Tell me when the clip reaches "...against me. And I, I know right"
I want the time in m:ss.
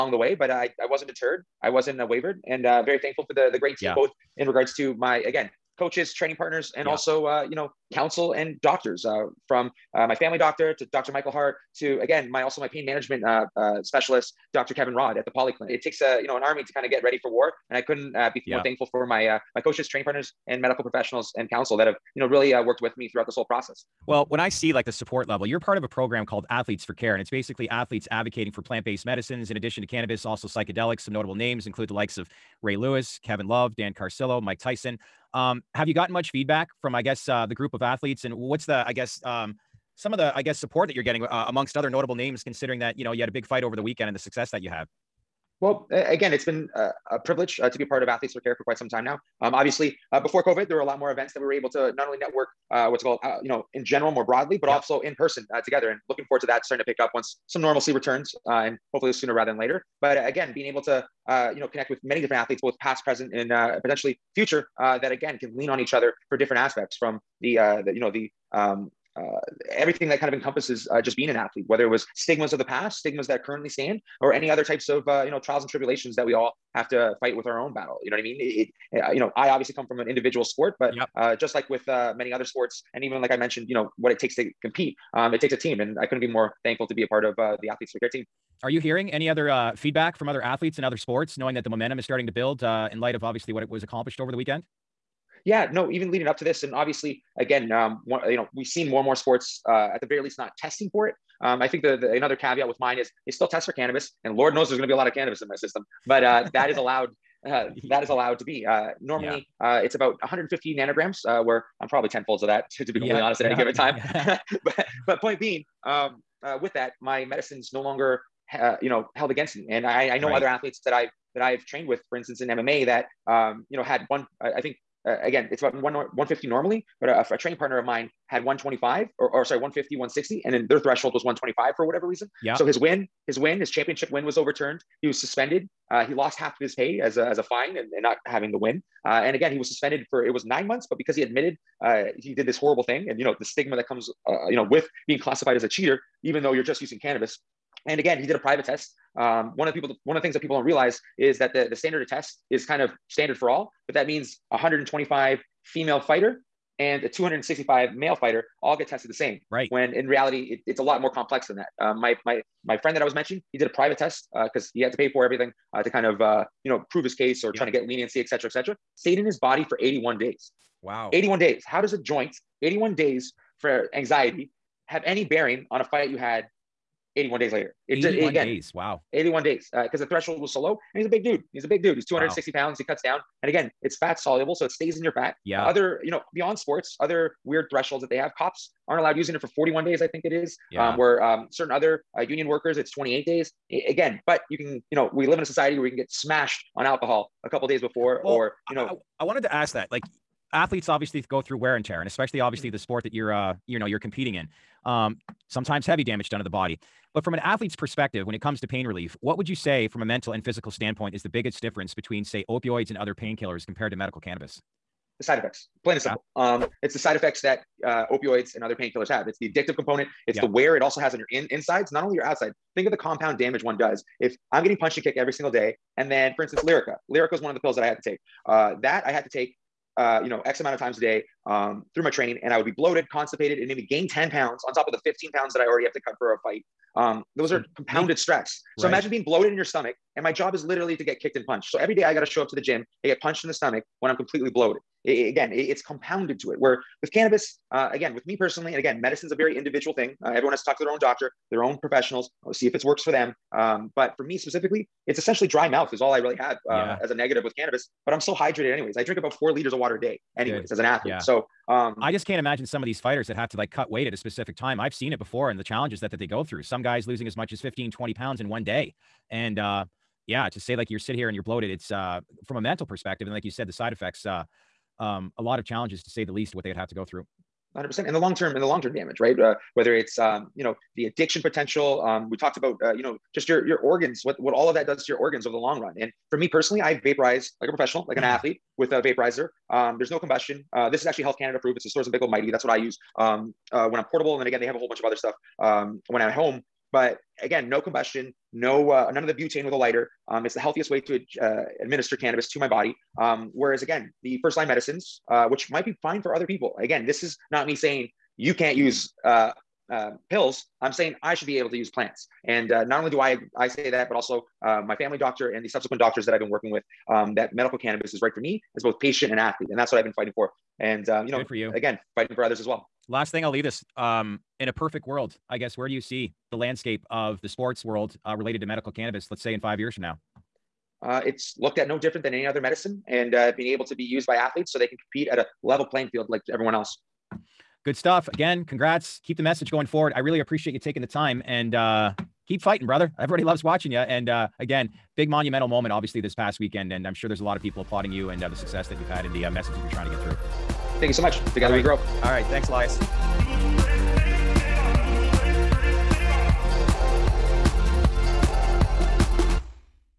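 1:59.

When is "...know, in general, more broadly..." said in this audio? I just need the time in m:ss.
0:53.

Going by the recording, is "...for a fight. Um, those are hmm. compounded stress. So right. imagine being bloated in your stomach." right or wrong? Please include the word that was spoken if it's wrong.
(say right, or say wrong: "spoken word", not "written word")
right.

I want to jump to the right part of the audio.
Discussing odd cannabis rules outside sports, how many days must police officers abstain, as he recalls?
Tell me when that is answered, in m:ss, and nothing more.
3:09.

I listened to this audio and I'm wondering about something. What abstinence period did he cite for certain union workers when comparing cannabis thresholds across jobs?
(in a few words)
28 days.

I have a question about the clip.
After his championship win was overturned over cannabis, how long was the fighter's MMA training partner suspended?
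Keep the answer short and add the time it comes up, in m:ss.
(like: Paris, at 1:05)
9 months, at 2:20.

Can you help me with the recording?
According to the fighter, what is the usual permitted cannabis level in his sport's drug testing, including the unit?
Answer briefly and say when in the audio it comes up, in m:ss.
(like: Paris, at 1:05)
150 nanograms, at 1:50.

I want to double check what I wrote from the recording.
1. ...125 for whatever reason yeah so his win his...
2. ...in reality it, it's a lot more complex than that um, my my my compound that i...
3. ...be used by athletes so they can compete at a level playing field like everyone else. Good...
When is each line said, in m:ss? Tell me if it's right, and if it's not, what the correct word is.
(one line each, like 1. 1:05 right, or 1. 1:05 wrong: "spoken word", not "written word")
1. 2:11 right
2. 2:39 wrong: "friend", not "compound"
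3. 5:33 right.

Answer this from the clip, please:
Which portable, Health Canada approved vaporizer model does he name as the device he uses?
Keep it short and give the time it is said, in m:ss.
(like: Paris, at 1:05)
Storz and Bickel Mighty, at 4:51.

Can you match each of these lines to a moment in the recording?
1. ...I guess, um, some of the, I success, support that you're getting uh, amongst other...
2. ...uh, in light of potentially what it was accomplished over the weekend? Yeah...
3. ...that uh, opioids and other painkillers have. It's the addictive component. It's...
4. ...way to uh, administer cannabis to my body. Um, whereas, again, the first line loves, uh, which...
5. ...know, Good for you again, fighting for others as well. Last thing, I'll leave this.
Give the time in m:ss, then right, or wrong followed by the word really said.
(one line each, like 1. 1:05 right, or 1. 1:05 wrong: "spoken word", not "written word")
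1. 0:38 wrong: "guess", not "success"
2. 1:32 wrong: "obviously", not "potentially"
3. 3:37 right
4. 5:00 wrong: "medicines", not "loves"
5. 5:21 right.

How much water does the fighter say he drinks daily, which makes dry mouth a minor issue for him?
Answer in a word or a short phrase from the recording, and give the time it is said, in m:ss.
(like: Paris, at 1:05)
4 liters, at 4:19.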